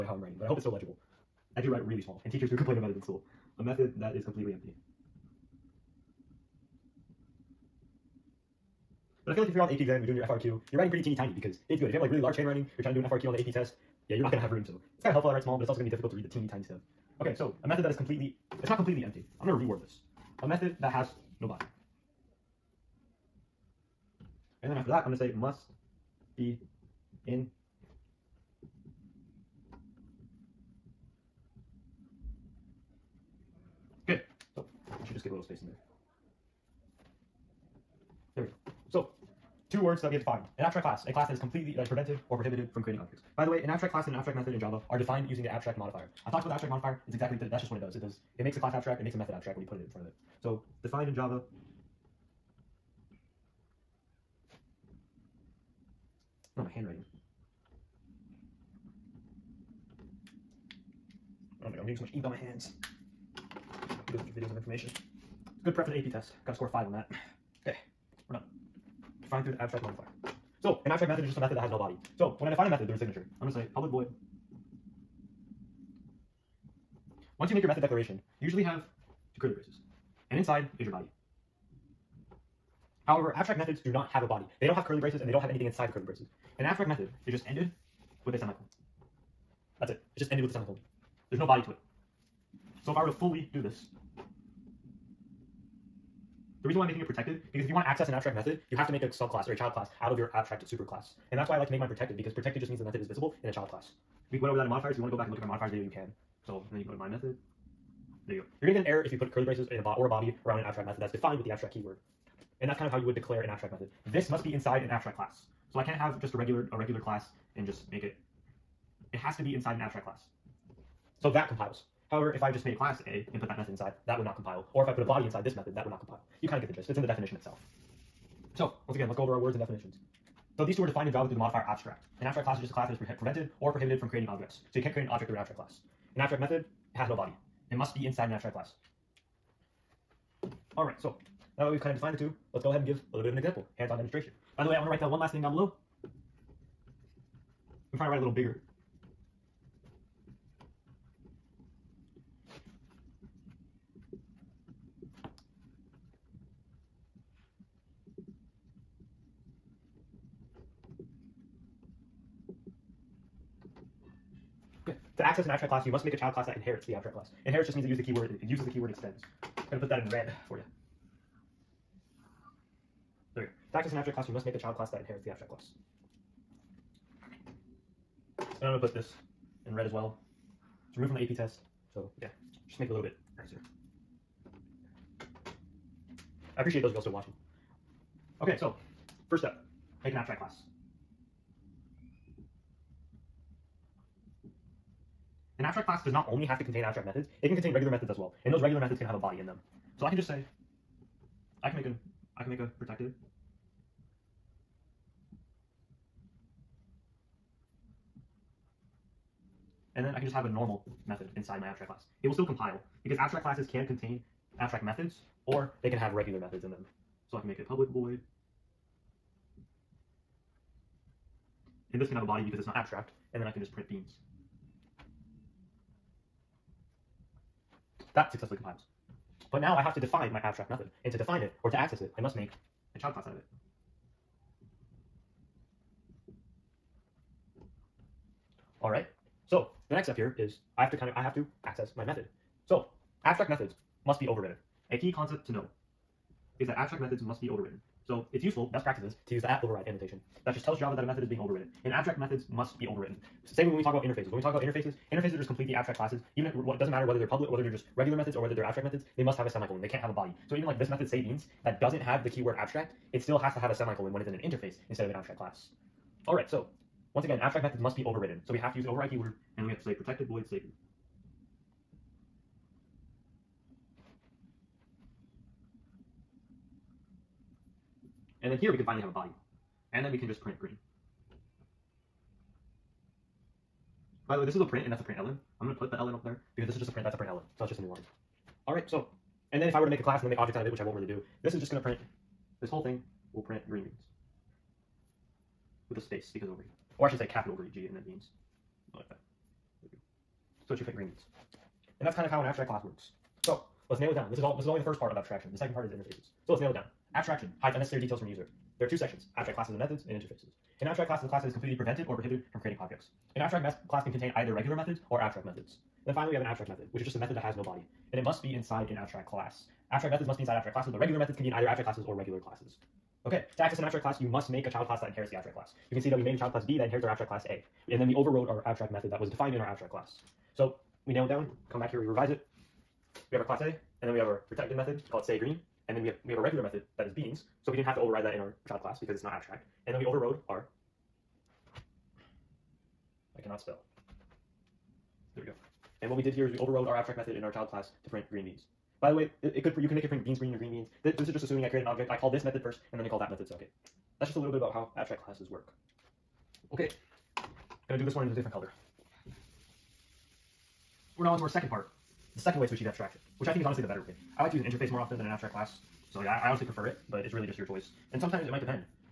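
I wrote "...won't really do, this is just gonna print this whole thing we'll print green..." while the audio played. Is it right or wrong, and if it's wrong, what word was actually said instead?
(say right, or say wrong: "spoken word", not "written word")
right.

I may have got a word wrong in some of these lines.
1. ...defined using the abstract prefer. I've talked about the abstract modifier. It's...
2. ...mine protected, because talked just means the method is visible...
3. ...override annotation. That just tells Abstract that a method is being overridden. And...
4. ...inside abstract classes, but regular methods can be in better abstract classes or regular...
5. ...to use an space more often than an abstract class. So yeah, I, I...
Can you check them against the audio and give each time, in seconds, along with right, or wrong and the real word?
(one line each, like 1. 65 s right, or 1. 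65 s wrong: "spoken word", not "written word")
1. 44 s wrong: "modifier", not "prefer"
2. 101 s wrong: "protected", not "talked"
3. 249 s wrong: "Java", not "Abstract"
4. 320 s wrong: "either", not "better"
5. 364 s wrong: "interface", not "space".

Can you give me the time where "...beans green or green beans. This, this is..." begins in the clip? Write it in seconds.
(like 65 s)
350 s.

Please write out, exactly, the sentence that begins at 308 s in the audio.
There are two sections, abstract classes and methods, and interfaces.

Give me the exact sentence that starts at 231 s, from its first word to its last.
And to define it, or to access it, I must make a child class out of it.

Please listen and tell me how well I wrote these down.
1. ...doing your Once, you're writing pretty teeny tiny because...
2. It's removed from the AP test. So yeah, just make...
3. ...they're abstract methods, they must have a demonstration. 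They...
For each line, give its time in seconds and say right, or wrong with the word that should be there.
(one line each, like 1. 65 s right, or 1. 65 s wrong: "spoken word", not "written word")
1. 10 s wrong: "FRQ", not "Once"
2. 180 s right
3. 258 s wrong: "semicolon", not "demonstration".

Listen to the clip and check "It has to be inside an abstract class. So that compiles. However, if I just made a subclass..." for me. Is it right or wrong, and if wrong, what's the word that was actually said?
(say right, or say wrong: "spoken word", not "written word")
wrong: "class", not "subclass".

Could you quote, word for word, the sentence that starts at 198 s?
And those regular methods can have a body in them.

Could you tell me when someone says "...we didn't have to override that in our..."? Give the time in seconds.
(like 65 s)
337 s.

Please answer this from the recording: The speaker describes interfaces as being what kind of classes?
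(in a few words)
completely abstract classes.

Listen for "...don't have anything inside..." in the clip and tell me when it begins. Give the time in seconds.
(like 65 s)
85 s.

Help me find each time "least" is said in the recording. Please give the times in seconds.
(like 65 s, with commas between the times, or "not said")
not said.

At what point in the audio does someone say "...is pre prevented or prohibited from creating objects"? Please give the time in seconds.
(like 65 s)
132 s.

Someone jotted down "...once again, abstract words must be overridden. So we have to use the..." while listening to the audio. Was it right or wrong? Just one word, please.
wrong.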